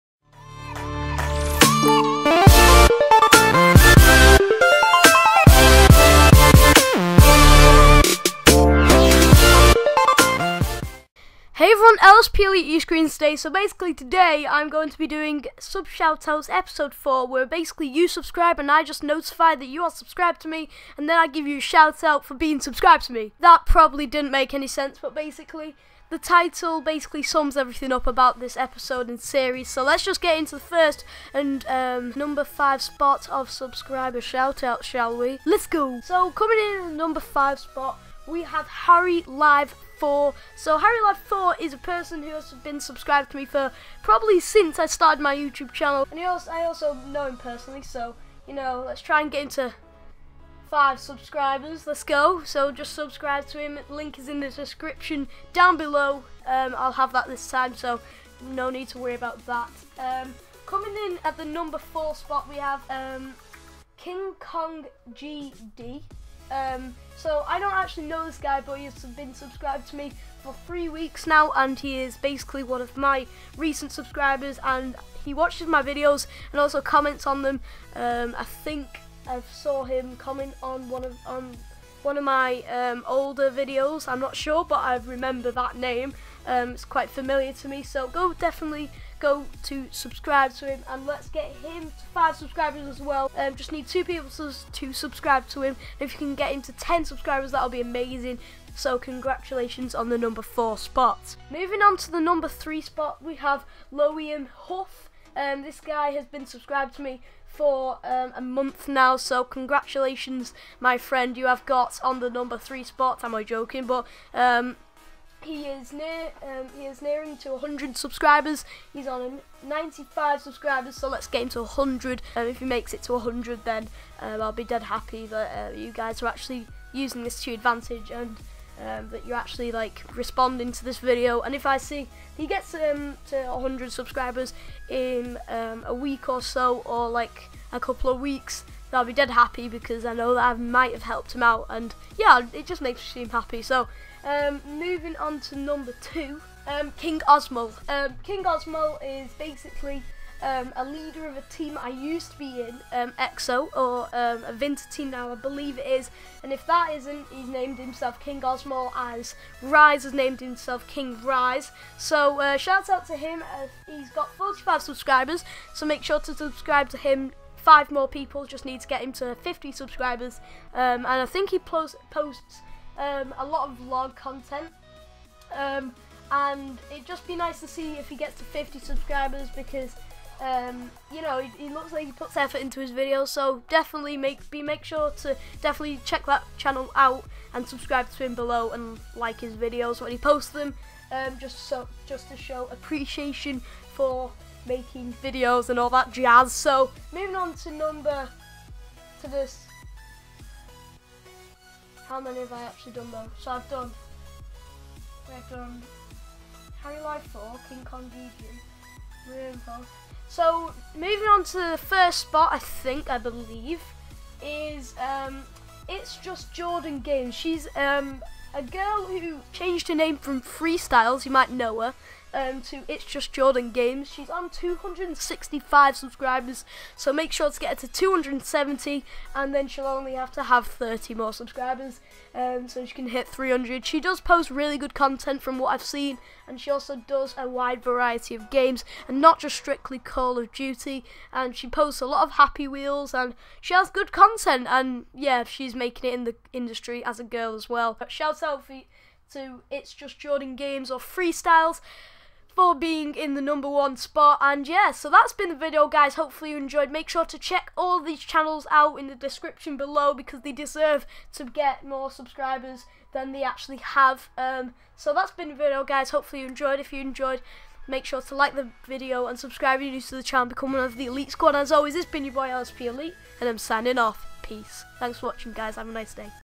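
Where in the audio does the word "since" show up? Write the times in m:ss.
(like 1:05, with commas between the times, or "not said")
0:44.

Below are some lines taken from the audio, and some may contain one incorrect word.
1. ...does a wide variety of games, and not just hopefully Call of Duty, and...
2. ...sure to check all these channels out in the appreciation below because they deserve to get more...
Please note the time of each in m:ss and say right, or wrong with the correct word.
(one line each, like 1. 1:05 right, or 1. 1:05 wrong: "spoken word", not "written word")
1. 3:57 wrong: "strictly", not "hopefully"
2. 4:17 wrong: "description", not "appreciation".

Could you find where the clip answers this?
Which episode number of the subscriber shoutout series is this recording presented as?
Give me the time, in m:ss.
0:16.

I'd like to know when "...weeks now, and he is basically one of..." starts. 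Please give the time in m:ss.
1:10.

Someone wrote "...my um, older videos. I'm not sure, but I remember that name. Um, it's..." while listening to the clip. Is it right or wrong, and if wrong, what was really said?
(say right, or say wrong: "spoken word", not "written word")
right.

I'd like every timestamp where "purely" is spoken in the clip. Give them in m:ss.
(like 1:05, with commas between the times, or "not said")
0:12.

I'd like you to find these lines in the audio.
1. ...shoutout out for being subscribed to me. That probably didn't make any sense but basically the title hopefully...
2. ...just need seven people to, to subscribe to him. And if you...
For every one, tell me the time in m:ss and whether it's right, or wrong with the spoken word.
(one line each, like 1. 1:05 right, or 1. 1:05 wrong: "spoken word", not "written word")
1. 0:21 wrong: "basically", not "hopefully"
2. 1:33 wrong: "two", not "seven".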